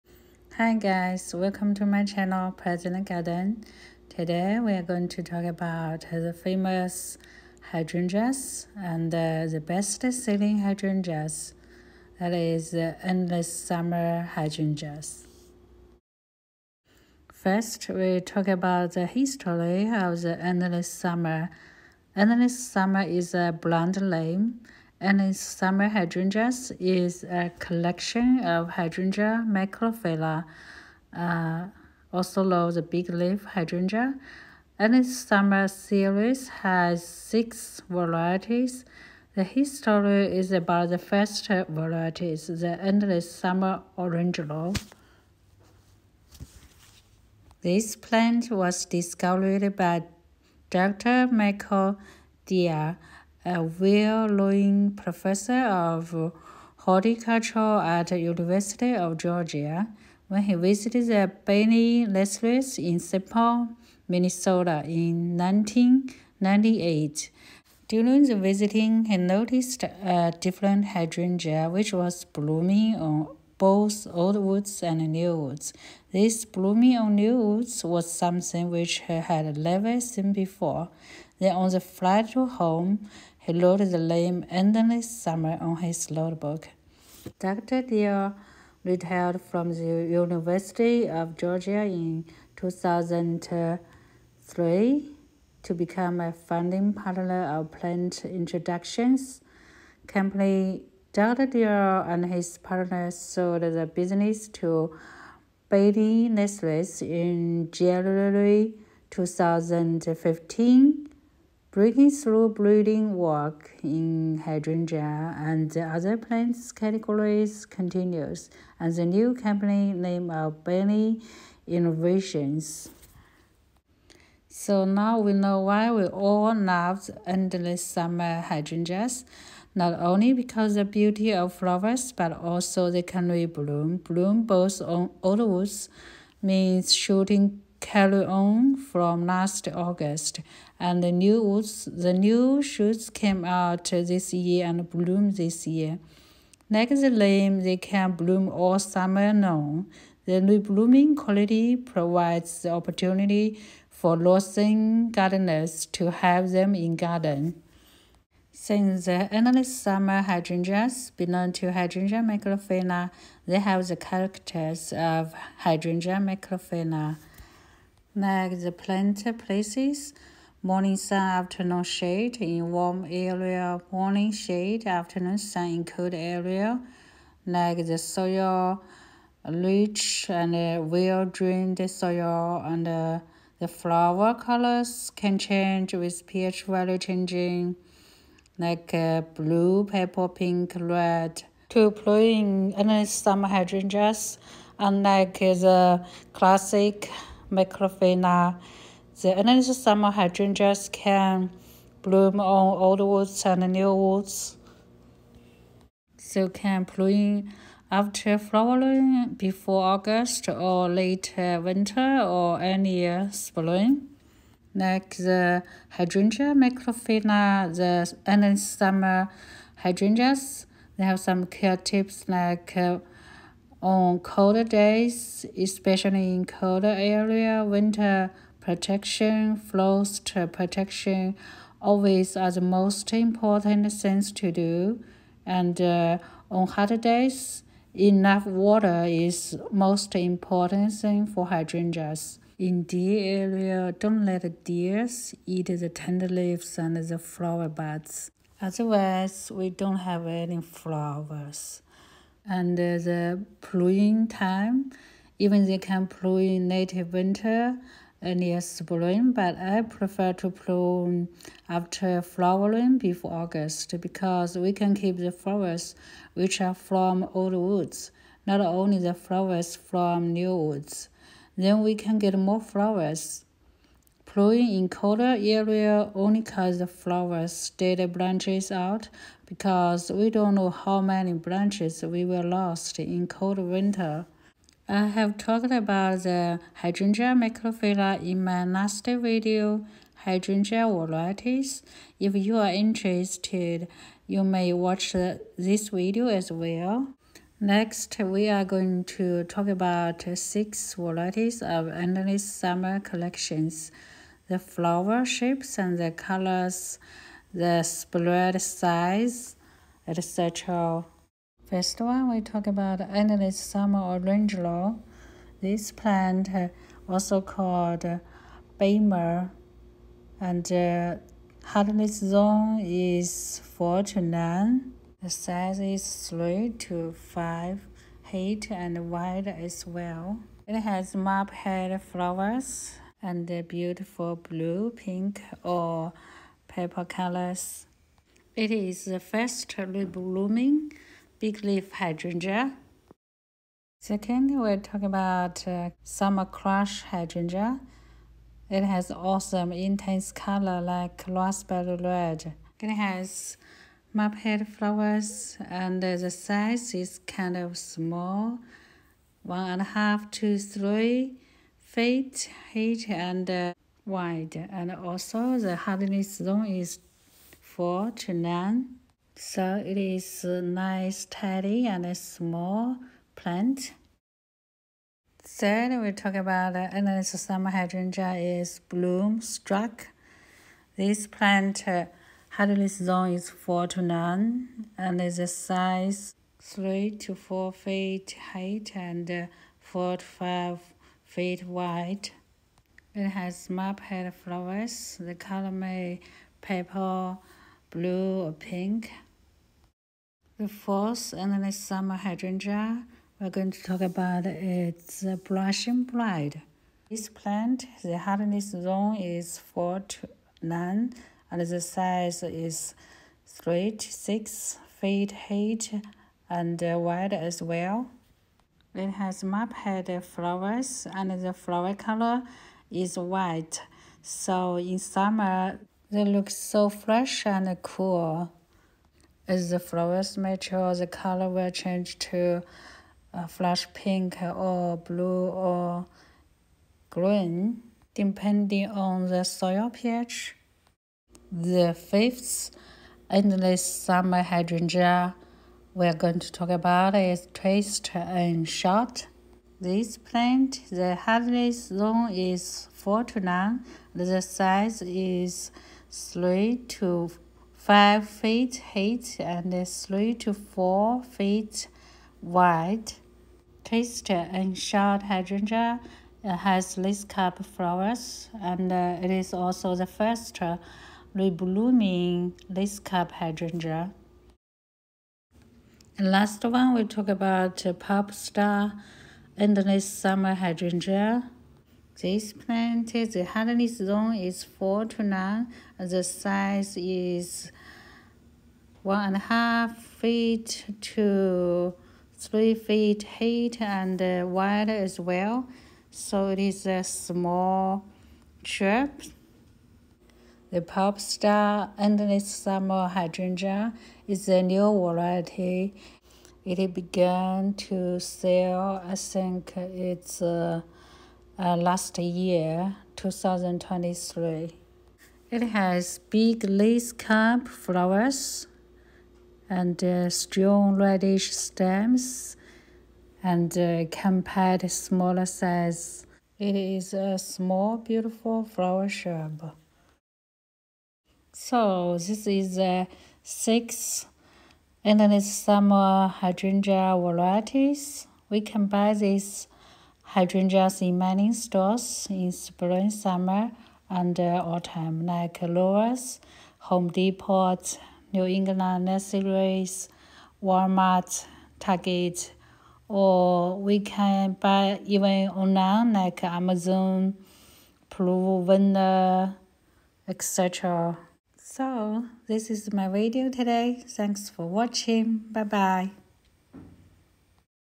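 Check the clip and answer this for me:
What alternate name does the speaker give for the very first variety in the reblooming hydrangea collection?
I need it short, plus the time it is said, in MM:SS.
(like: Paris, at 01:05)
Bailmer, at 05:18.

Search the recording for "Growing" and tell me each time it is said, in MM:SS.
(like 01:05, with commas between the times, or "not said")
04:34.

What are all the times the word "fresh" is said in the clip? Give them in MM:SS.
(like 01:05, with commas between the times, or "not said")
07:06.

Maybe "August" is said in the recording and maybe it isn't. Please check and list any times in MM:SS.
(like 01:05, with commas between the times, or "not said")
02:19, 03:29, 04:23.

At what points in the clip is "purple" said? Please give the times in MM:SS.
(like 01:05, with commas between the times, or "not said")
03:09, 05:36, 06:36.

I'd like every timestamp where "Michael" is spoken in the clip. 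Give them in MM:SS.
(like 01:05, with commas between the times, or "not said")
00:51.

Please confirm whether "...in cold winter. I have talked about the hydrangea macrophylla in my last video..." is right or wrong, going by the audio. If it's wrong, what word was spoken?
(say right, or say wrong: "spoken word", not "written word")
right.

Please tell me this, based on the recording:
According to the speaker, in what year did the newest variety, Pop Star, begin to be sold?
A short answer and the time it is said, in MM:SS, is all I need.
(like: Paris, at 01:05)
2023, at 08:33.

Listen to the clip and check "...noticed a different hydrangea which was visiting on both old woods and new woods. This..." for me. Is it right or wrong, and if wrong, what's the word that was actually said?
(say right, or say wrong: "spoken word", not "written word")
wrong: "blooming", not "visiting".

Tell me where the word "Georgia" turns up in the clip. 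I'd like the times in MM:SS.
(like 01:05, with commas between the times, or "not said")
00:59, 01:31.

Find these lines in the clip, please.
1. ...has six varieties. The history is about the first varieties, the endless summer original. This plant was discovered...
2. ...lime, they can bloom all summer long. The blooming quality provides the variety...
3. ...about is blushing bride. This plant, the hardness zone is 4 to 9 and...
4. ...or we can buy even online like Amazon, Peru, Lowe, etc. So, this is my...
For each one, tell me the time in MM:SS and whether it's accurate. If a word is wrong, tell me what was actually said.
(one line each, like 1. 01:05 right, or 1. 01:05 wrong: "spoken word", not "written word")
1. 00:36 right
2. 02:27 wrong: "opportunity", not "variety"
3. 06:44 right
4. 09:13 wrong: "Vendor", not "Lowe".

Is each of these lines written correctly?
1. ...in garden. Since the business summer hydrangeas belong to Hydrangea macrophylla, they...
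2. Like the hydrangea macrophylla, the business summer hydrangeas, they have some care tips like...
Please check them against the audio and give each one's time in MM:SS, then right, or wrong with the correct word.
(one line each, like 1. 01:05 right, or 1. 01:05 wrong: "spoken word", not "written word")
1. 02:36 wrong: "endless", not "business"
2. 03:34 wrong: "endless", not "business".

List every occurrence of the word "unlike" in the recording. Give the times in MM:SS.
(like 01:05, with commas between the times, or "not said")
03:14.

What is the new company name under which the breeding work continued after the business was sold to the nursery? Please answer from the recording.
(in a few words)
Bailey Innovations.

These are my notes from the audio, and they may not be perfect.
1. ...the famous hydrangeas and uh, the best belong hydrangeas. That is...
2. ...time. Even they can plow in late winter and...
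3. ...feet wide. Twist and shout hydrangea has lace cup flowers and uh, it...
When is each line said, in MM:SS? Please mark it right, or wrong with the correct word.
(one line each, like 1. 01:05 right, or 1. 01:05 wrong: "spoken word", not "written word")
1. 00:06 wrong: "selling", not "belong"
2. 04:14 right
3. 07:41 right.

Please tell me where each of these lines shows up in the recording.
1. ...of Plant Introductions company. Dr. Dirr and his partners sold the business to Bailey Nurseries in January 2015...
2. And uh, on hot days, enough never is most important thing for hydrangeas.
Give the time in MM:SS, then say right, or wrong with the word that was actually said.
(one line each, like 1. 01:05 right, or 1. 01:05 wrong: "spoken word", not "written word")
1. 01:37 right
2. 03:55 wrong: "water", not "never".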